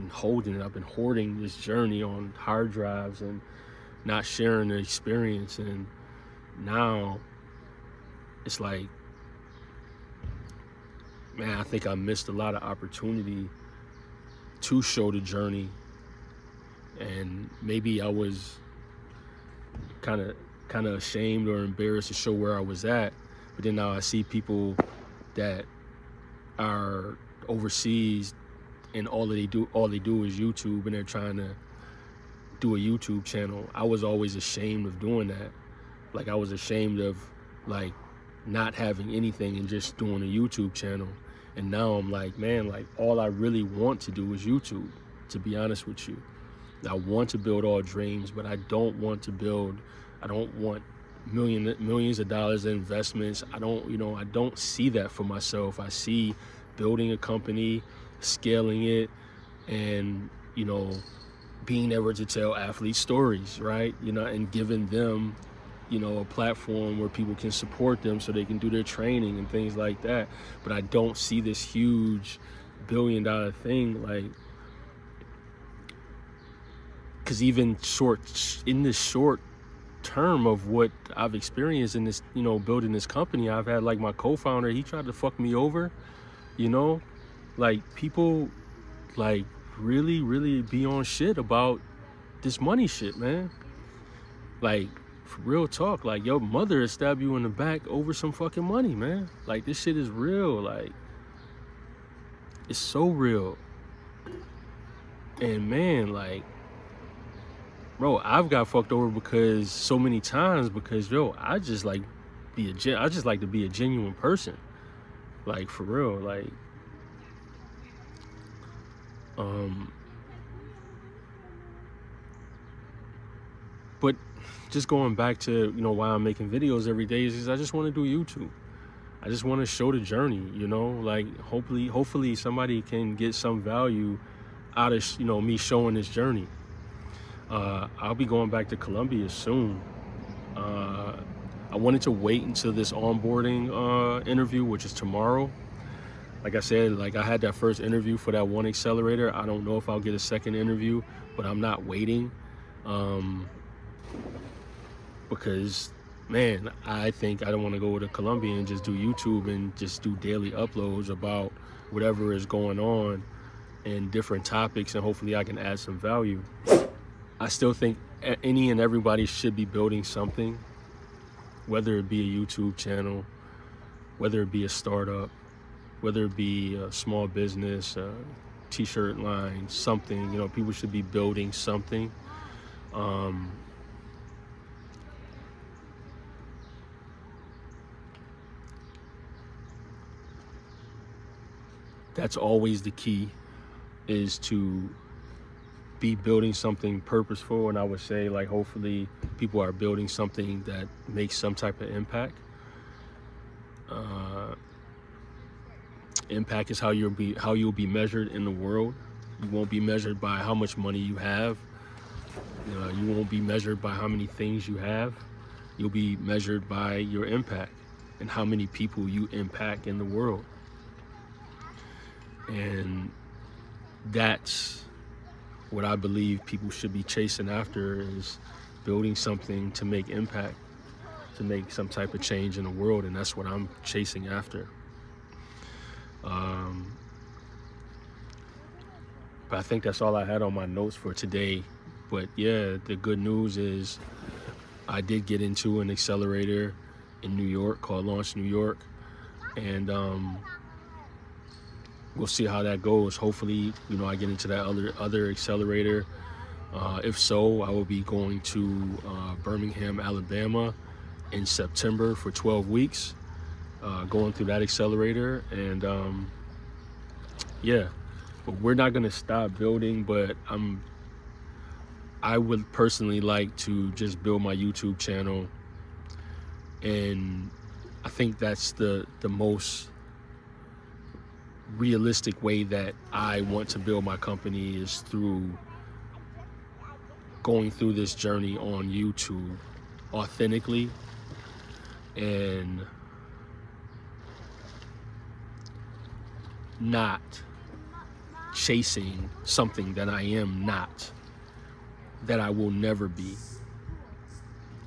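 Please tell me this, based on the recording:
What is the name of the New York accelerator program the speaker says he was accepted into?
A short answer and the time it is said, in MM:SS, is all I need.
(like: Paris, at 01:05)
Launch New York, at 04:08.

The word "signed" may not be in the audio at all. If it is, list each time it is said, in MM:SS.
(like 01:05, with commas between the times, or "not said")
not said.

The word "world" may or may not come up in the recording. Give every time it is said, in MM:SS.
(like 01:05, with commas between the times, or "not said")
03:28, 03:40, 03:52.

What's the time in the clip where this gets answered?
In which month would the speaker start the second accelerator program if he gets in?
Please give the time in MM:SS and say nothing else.
04:21.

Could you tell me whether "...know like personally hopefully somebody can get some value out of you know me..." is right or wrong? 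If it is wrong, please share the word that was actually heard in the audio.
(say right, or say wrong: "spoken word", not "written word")
wrong: "hopefully", not "personally".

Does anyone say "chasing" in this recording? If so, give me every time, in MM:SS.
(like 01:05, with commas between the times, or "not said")
03:47, 03:53, 04:58.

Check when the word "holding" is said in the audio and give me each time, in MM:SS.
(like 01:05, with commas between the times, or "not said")
00:00.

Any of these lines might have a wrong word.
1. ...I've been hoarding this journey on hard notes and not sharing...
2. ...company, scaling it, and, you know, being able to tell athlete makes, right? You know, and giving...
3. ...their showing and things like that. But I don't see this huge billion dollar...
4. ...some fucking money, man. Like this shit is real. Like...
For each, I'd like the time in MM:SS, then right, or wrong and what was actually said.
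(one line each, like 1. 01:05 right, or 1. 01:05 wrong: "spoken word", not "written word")
1. 00:00 wrong: "drives", not "notes"
2. 00:57 wrong: "stories", not "makes"
3. 01:08 wrong: "training", not "showing"
4. 01:38 right.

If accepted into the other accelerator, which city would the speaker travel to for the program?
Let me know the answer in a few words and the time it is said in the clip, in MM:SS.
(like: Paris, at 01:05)
Birmingham, Alabama, at 04:19.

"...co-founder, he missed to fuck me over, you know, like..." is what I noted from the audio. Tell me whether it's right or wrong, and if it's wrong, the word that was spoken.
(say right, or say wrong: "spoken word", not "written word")
wrong: "tried", not "missed".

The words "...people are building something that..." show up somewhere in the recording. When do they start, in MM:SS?
03:19.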